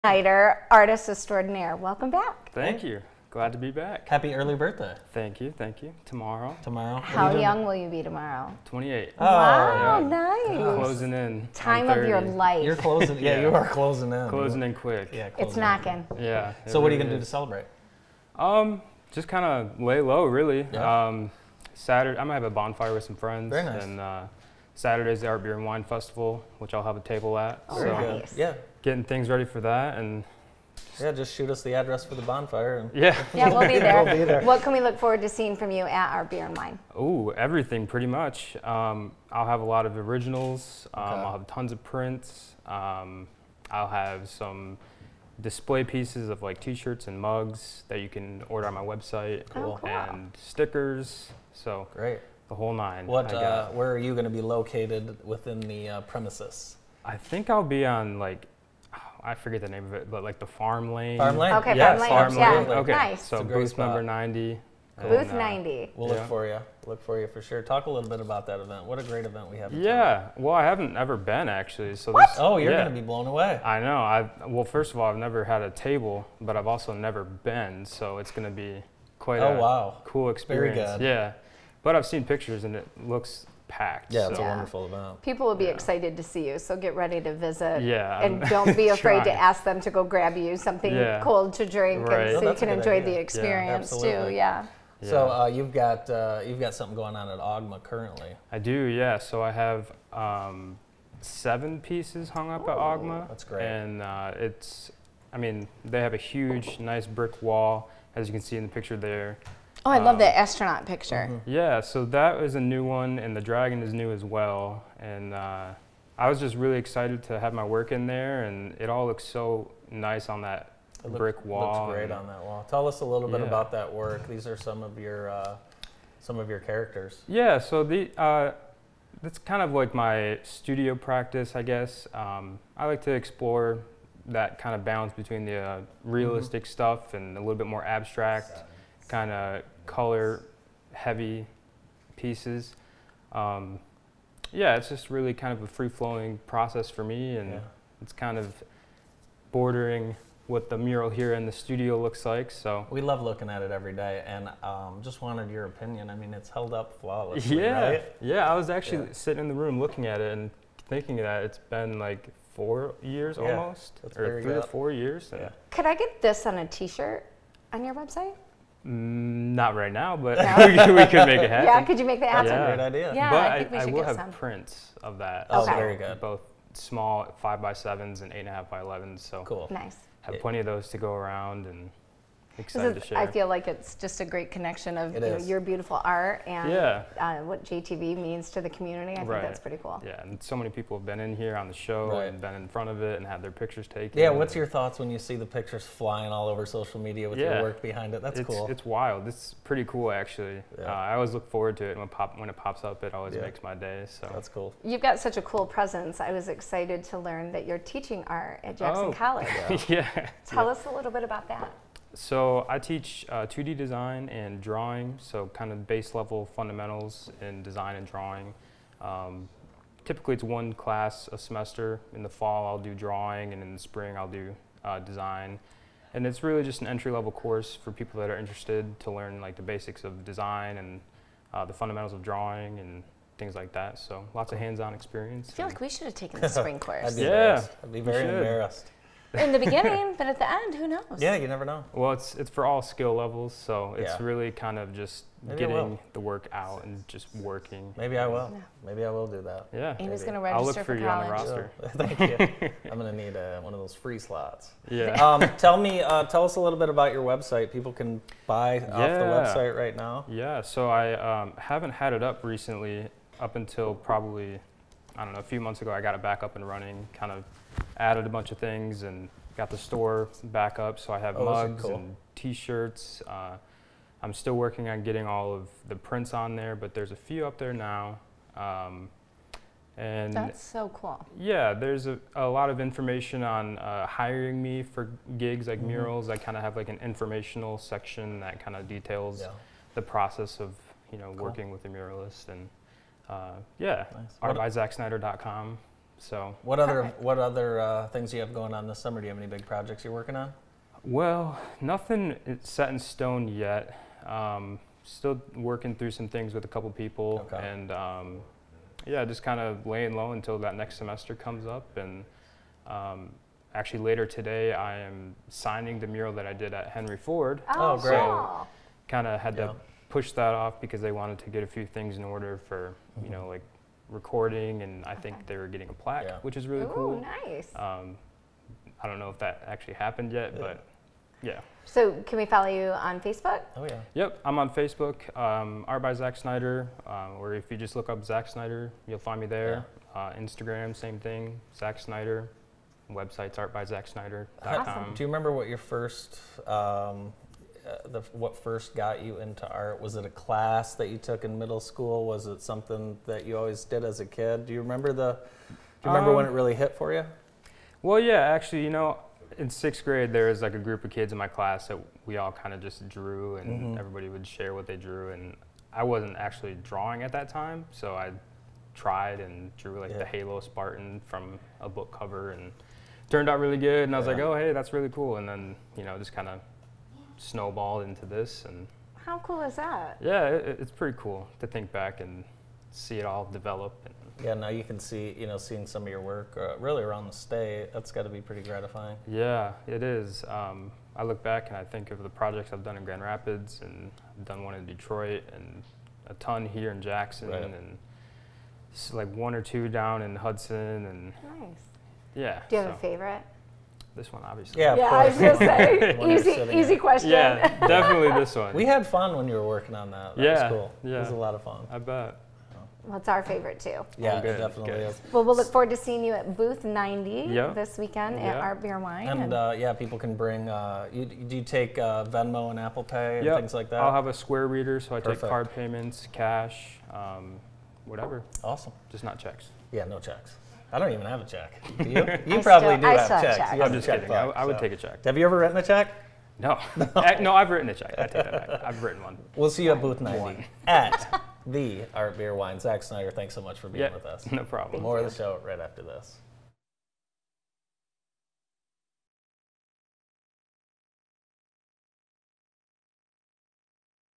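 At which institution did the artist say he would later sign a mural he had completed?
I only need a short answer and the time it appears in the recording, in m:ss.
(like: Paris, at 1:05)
Henry Ford, at 5:16.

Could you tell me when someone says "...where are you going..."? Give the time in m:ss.
0:53.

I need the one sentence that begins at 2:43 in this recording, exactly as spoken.
almost, That's or three or four years.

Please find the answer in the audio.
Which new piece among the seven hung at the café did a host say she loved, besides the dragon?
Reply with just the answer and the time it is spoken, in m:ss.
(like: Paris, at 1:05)
Astronaut, at 1:50.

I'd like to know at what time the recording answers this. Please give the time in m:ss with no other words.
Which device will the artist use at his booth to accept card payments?
7:04.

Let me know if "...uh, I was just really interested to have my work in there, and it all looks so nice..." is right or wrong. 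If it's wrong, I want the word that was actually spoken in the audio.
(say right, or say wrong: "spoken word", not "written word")
wrong: "excited", not "interested".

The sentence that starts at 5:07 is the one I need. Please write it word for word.
and um, yeah, just kind of laying low until that next semester comes up.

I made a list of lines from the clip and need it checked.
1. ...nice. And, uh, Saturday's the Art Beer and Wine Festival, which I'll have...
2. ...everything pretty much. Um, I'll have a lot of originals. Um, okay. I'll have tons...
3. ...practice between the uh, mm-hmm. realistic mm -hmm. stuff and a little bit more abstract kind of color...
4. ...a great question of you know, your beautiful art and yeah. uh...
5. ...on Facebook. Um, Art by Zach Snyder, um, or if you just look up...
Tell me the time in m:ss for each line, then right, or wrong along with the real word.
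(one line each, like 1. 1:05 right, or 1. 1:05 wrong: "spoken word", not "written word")
1. 0:23 right
2. 0:37 right
3. 2:14 wrong: "balance", not "practice"
4. 3:04 wrong: "connection", not "question"
5. 5:34 right.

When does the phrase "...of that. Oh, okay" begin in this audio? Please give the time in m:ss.
2:55.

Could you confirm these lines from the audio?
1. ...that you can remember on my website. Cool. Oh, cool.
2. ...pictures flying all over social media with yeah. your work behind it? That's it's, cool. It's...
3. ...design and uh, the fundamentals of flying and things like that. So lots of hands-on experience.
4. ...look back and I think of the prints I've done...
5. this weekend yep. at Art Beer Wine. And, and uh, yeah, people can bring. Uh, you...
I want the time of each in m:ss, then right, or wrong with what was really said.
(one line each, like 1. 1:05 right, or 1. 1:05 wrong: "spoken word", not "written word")
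1. 0:47 wrong: "order", not "remember"
2. 3:15 right
3. 3:50 wrong: "drawing", not "flying"
4. 6:31 wrong: "projects", not "prints"
5. 6:57 right.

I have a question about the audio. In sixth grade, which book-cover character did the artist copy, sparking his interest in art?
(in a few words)
Halo Spartan.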